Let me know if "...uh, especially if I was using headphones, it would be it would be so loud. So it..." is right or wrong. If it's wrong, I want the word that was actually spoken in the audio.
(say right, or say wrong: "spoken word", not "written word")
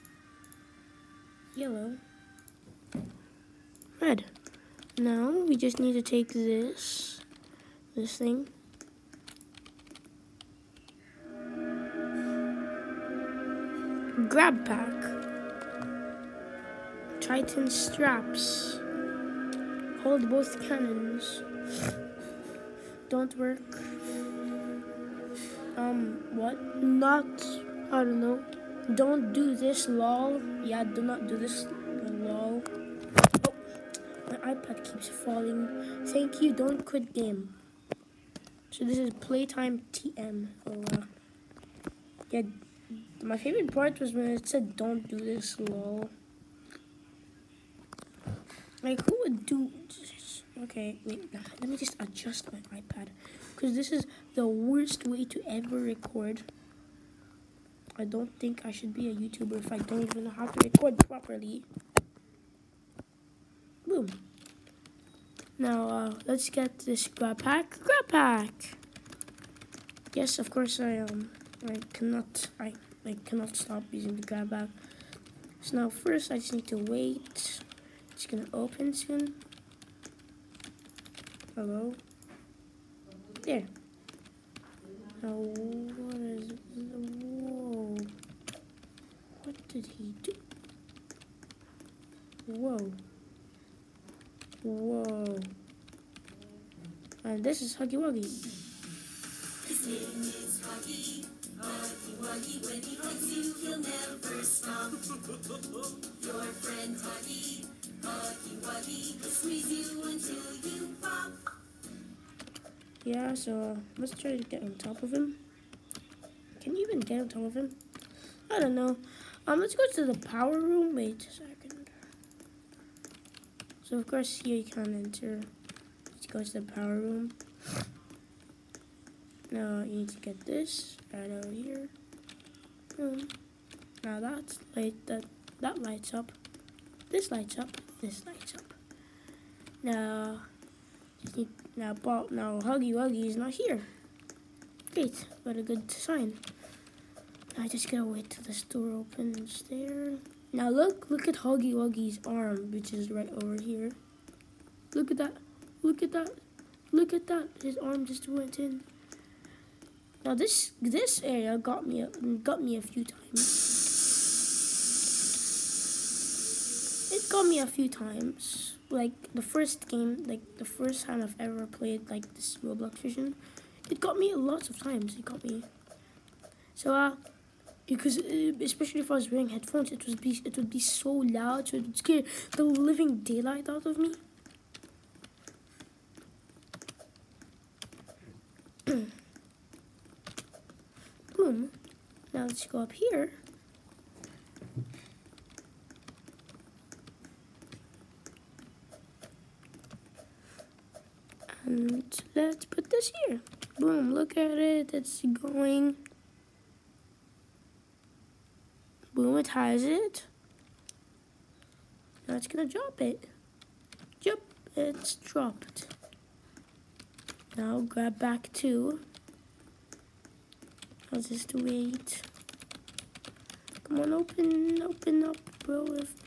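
wrong: "wearing", not "using".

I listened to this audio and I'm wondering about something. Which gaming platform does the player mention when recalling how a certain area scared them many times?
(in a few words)
Roblox.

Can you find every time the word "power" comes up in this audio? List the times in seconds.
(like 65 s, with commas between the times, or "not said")
120 s, 126 s.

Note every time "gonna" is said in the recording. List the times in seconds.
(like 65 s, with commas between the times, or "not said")
78 s, 212 s.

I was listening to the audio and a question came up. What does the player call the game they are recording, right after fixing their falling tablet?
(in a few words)
Playtime TM.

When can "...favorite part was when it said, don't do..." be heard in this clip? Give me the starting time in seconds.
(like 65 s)
43 s.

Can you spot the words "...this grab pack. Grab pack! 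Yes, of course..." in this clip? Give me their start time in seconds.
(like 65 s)
66 s.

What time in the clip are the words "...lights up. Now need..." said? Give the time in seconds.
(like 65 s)
138 s.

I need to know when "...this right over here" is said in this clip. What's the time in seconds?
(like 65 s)
130 s.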